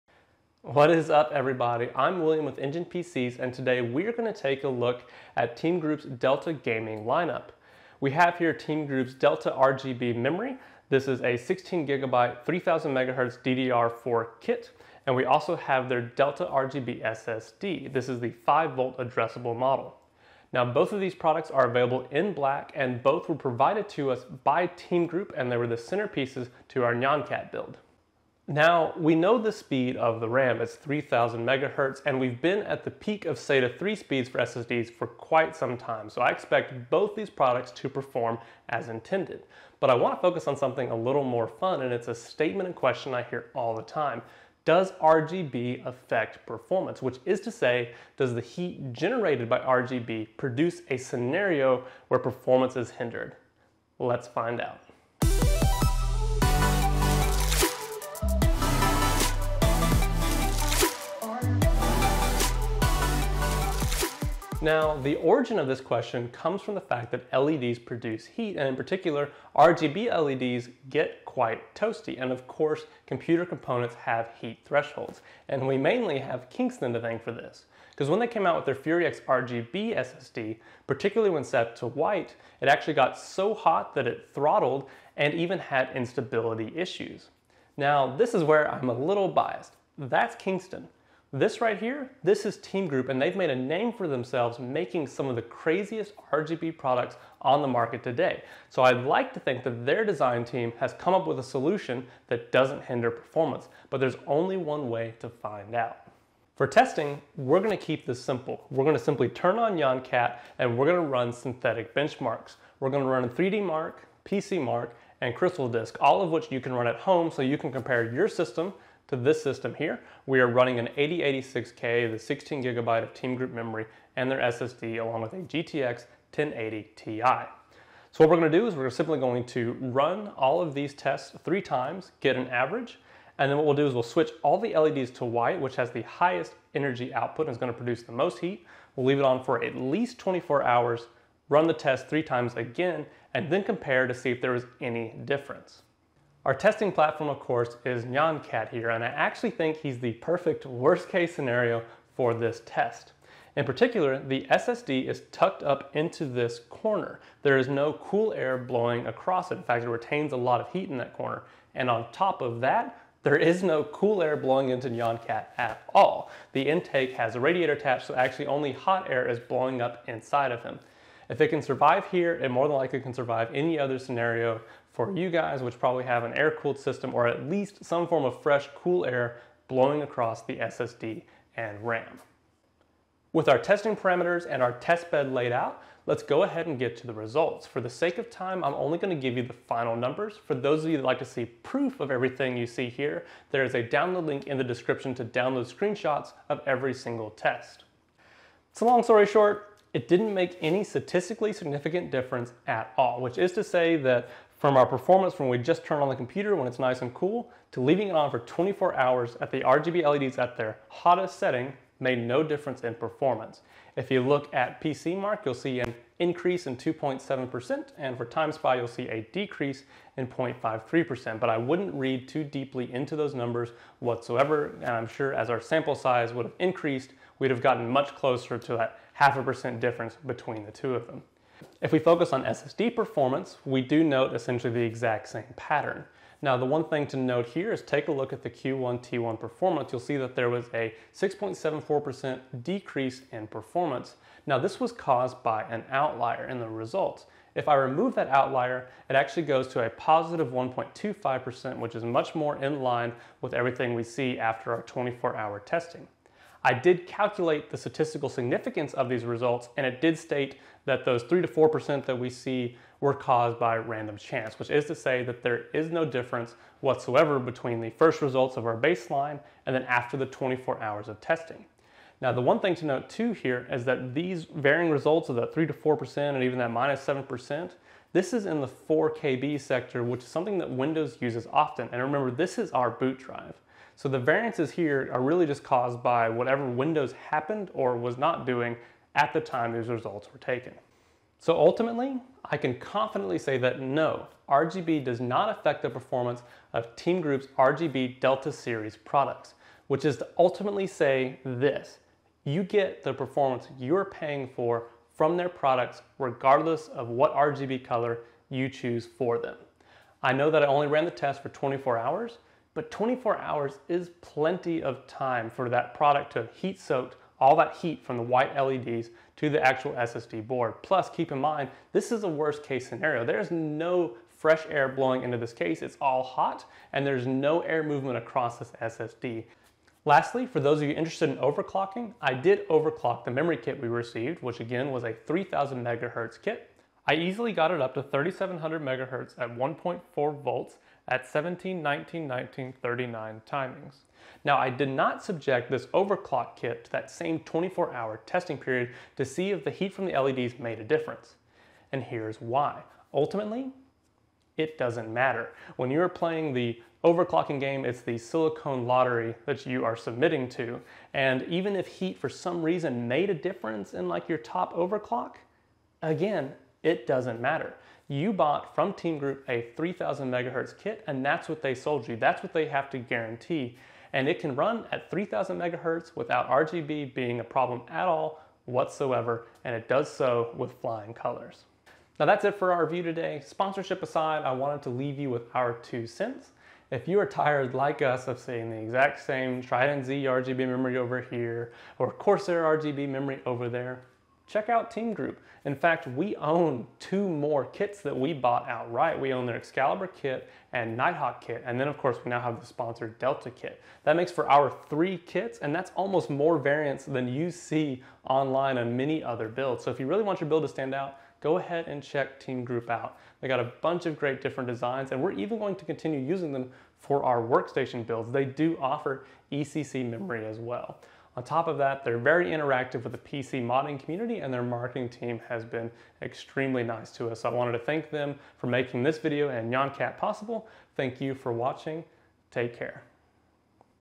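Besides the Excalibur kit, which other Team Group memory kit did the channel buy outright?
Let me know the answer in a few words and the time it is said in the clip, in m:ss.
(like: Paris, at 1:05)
Nighthawk, at 6:40.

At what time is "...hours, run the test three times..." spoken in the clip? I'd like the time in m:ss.
2:20.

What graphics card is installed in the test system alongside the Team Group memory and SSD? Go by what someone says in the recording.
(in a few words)
GTX 1080 Ti.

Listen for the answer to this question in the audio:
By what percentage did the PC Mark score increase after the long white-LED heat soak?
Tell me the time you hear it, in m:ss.
3:36.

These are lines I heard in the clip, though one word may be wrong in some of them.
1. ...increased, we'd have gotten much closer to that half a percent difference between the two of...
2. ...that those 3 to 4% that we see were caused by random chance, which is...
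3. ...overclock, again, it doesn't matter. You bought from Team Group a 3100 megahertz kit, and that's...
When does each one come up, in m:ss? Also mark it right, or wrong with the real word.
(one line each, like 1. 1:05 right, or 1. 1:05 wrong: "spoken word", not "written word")
1. 3:46 right
2. 4:20 right
3. 6:04 wrong: "3000", not "3100".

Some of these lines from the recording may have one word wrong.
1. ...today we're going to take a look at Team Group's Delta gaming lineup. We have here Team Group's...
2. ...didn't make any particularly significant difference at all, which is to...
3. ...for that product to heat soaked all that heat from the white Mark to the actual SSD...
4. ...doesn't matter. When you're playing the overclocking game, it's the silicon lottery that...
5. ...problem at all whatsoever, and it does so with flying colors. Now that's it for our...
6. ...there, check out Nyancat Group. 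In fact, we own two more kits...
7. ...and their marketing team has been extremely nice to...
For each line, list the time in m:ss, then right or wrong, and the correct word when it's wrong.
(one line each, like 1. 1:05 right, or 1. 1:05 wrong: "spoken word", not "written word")
1. 0:03 right
2. 3:20 wrong: "statistically", not "particularly"
3. 5:15 wrong: "LEDs", not "Mark"
4. 5:54 right
5. 6:17 right
6. 6:33 wrong: "Team", not "Nyancat"
7. 7:04 right.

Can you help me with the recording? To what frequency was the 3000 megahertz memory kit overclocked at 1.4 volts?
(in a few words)
3700 megahertz.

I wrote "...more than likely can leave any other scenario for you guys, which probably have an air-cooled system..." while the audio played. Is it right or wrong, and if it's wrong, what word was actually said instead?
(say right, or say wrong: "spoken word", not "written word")
wrong: "survive", not "leave".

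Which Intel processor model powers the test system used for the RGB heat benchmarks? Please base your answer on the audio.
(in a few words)
8086K.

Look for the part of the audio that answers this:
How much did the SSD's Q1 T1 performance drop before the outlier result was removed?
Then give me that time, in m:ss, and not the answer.
4:01.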